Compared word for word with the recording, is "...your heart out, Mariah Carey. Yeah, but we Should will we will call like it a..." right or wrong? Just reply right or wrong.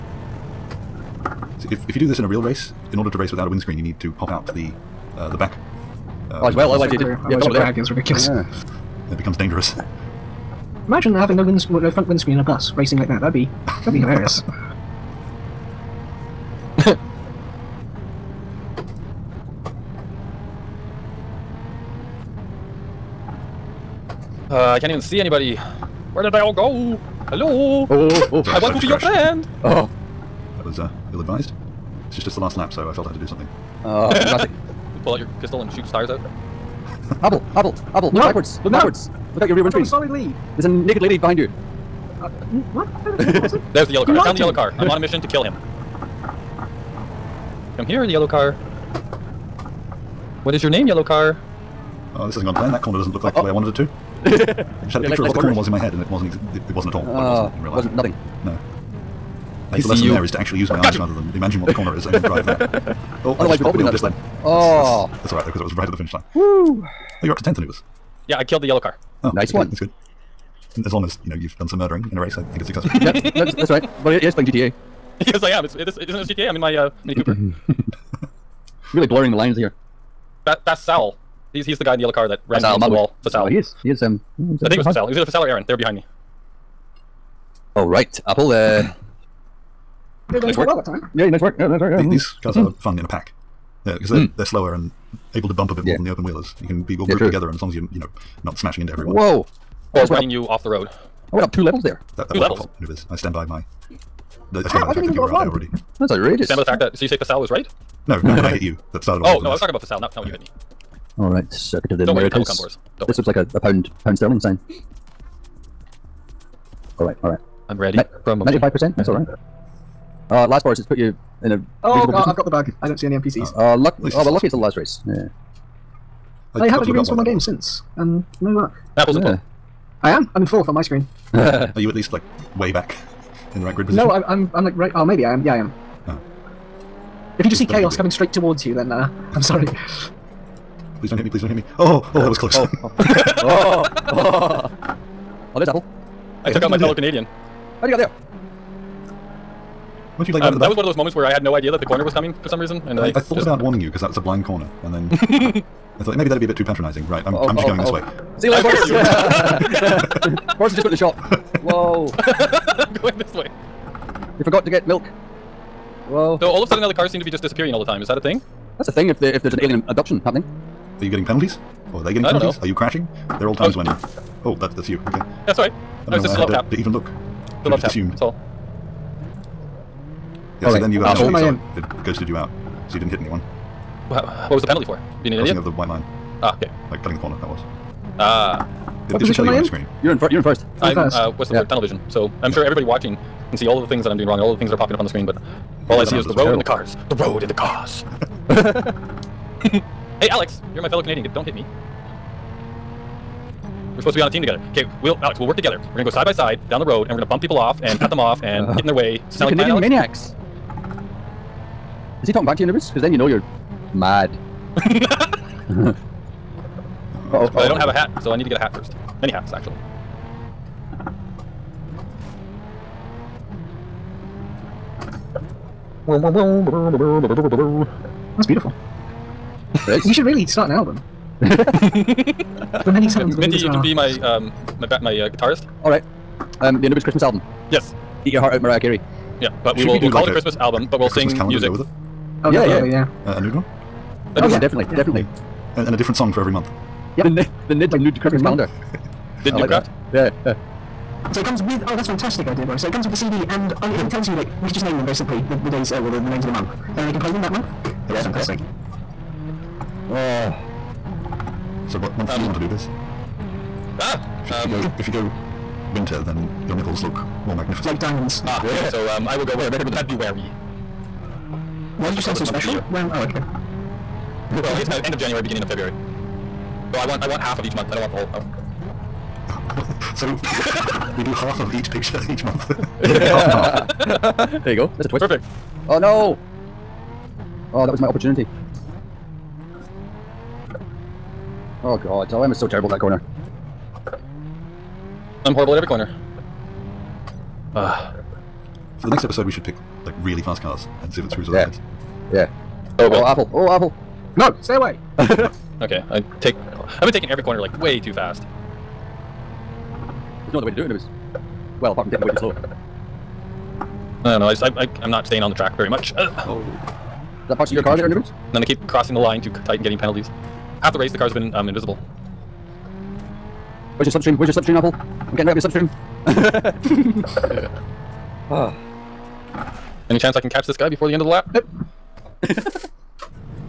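right.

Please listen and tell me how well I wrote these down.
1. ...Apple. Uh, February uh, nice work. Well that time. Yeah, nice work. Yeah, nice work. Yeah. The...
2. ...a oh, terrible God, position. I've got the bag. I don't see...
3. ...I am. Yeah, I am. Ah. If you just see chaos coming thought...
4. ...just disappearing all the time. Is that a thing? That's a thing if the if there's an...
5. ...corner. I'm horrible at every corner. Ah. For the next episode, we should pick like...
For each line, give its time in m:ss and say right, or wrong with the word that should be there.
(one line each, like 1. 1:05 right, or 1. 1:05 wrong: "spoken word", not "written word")
1. 1:28 wrong: "Did", not "February"
2. 2:01 wrong: "reasonable", not "terrible"
3. 2:15 wrong: "straight", not "thought"
4. 2:47 right
5. 4:52 right.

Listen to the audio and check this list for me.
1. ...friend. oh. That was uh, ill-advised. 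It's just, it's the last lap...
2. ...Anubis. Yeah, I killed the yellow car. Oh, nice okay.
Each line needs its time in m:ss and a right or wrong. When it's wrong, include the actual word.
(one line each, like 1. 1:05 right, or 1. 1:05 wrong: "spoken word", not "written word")
1. 0:28 right
2. 1:07 right.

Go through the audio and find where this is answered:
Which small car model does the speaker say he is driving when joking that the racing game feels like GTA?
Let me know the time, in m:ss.
1:17.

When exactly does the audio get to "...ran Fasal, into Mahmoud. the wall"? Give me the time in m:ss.
1:22.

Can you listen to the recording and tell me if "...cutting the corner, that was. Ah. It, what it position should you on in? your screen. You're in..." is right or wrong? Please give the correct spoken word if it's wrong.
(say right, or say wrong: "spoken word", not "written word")
right.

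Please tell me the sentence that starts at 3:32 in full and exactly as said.
Because then you know you're mad.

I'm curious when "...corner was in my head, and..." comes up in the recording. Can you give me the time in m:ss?
0:55.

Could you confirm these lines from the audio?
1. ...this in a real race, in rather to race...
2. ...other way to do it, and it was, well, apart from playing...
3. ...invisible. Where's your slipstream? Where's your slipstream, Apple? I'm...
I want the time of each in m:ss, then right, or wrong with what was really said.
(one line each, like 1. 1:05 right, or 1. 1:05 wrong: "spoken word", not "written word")
1. 0:02 wrong: "order", not "rather"
2. 5:10 wrong: "taking", not "playing"
3. 5:21 right.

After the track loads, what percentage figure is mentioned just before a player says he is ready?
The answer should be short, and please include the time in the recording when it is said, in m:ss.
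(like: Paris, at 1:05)
95%, at 1:57.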